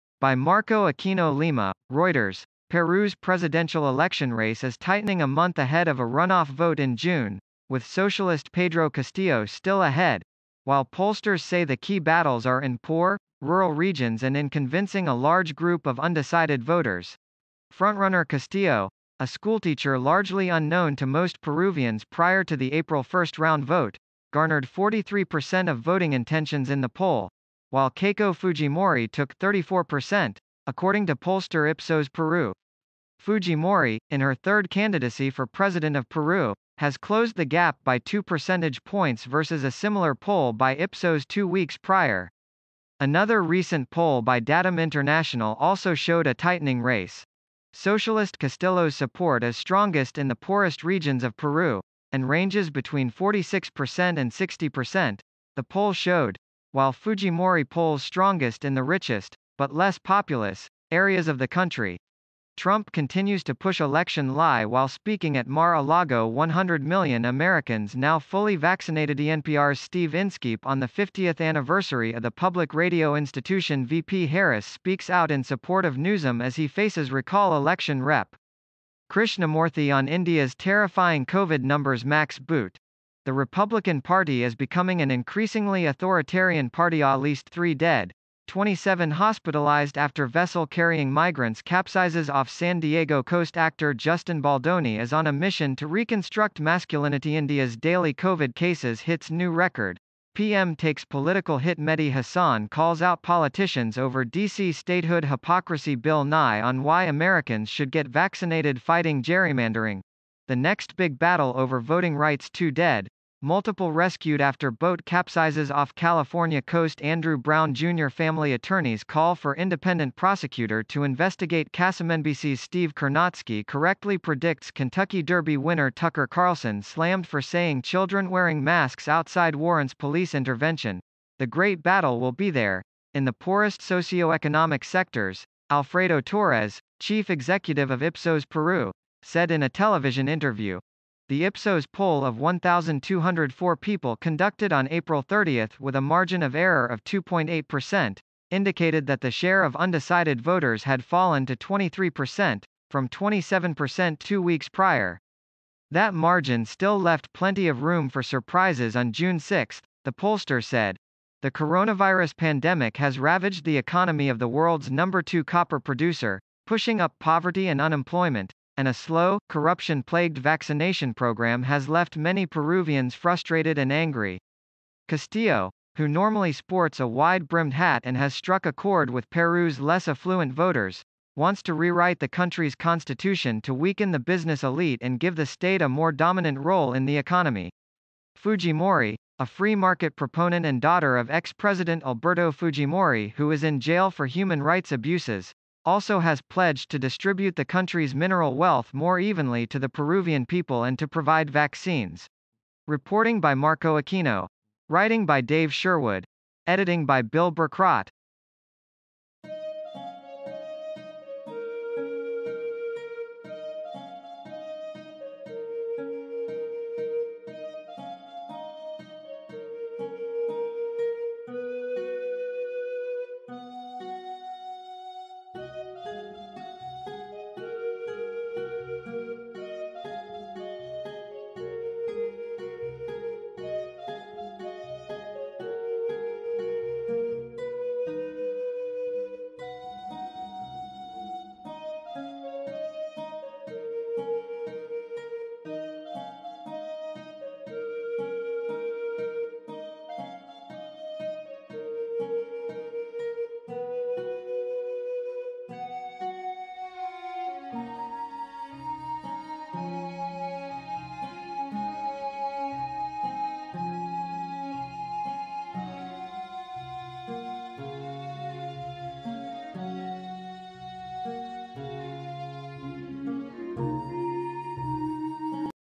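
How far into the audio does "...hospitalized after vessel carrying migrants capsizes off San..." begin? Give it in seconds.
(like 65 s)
89 s.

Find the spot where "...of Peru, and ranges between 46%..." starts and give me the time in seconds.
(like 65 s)
51 s.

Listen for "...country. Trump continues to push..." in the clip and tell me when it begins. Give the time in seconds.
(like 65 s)
61 s.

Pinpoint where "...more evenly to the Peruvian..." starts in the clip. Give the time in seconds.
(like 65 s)
198 s.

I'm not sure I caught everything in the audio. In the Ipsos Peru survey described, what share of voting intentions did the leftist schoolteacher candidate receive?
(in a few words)
43%.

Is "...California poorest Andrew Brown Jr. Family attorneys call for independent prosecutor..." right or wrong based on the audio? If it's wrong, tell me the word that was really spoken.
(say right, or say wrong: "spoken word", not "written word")
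wrong: "coast", not "poorest".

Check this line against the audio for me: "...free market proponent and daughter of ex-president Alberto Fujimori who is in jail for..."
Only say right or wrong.
right.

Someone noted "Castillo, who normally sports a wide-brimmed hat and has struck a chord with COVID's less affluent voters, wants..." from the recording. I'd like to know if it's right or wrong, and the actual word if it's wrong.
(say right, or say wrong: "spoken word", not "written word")
wrong: "Peru", not "COVID".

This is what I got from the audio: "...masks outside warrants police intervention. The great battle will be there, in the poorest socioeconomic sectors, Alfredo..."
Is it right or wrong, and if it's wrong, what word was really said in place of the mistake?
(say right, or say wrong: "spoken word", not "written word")
right.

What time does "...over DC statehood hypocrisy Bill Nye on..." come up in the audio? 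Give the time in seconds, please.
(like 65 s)
103 s.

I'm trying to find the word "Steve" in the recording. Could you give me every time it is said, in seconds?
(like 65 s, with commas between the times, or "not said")
69 s, 122 s.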